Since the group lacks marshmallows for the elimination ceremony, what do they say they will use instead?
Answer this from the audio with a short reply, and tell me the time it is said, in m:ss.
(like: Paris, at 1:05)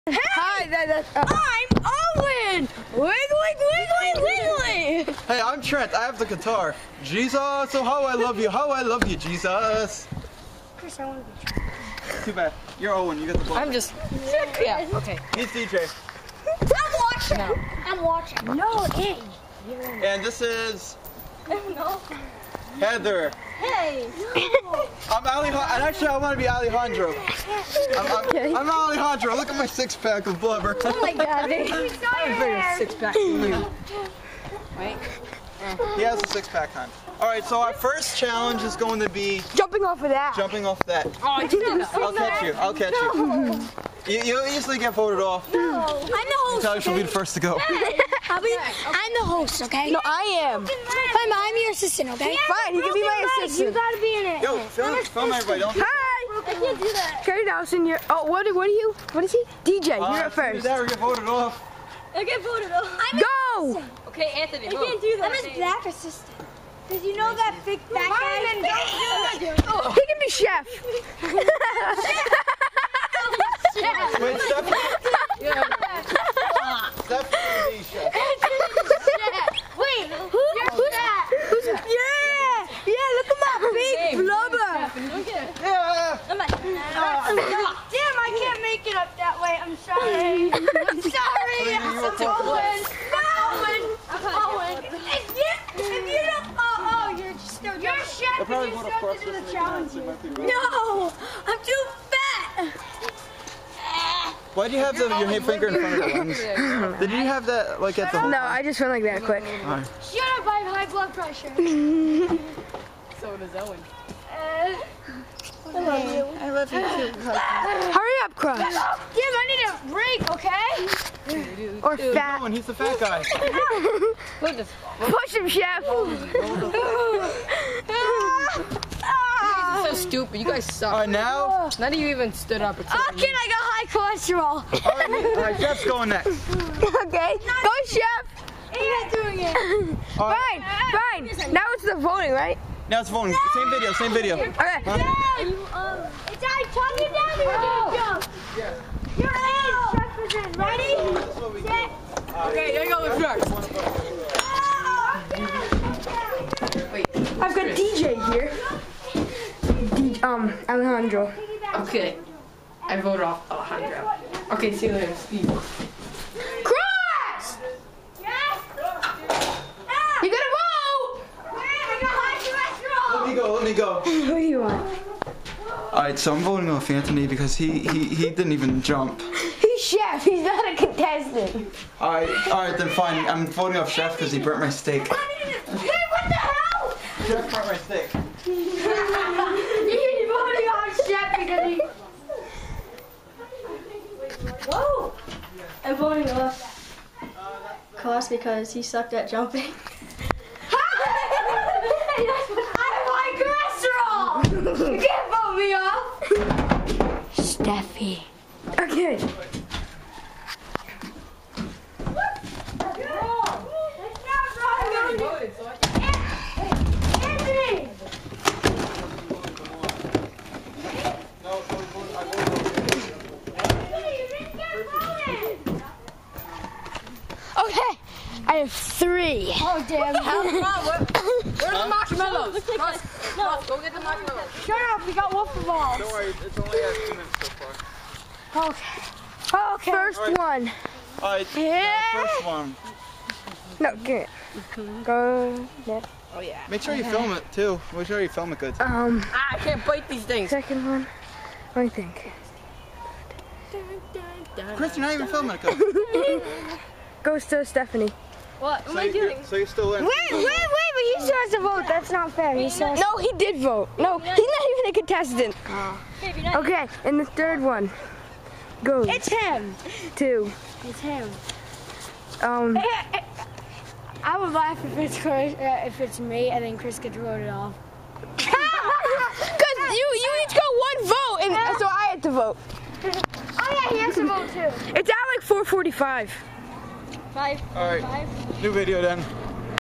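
waffle balls, at 3:55.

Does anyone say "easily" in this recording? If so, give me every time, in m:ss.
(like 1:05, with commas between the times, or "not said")
0:44.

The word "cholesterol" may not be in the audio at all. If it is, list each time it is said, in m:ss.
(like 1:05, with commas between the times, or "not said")
2:13, 3:24.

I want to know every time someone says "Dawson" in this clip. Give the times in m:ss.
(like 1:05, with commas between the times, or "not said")
0:57.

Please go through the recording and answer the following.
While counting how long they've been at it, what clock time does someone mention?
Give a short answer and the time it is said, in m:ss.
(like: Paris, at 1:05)
4:45, at 4:45.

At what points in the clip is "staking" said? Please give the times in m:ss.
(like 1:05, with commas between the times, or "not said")
not said.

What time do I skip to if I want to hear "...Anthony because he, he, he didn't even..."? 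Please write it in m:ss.
2:56.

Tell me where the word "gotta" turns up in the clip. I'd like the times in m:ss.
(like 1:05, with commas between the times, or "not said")
0:53, 2:50.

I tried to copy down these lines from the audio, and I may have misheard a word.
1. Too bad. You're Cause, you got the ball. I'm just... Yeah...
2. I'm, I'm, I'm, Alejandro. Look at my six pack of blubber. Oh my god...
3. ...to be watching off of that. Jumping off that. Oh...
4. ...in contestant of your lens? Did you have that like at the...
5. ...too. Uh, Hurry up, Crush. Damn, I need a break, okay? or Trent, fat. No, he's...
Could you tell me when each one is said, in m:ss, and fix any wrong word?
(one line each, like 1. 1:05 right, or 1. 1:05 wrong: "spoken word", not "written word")
1. 0:12 wrong: "Owen", not "Cause"
2. 0:27 right
3. 0:38 wrong: "jumping", not "watching"
4. 1:45 wrong: "front", not "contestant"
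5. 1:56 wrong: "Dude", not "Trent".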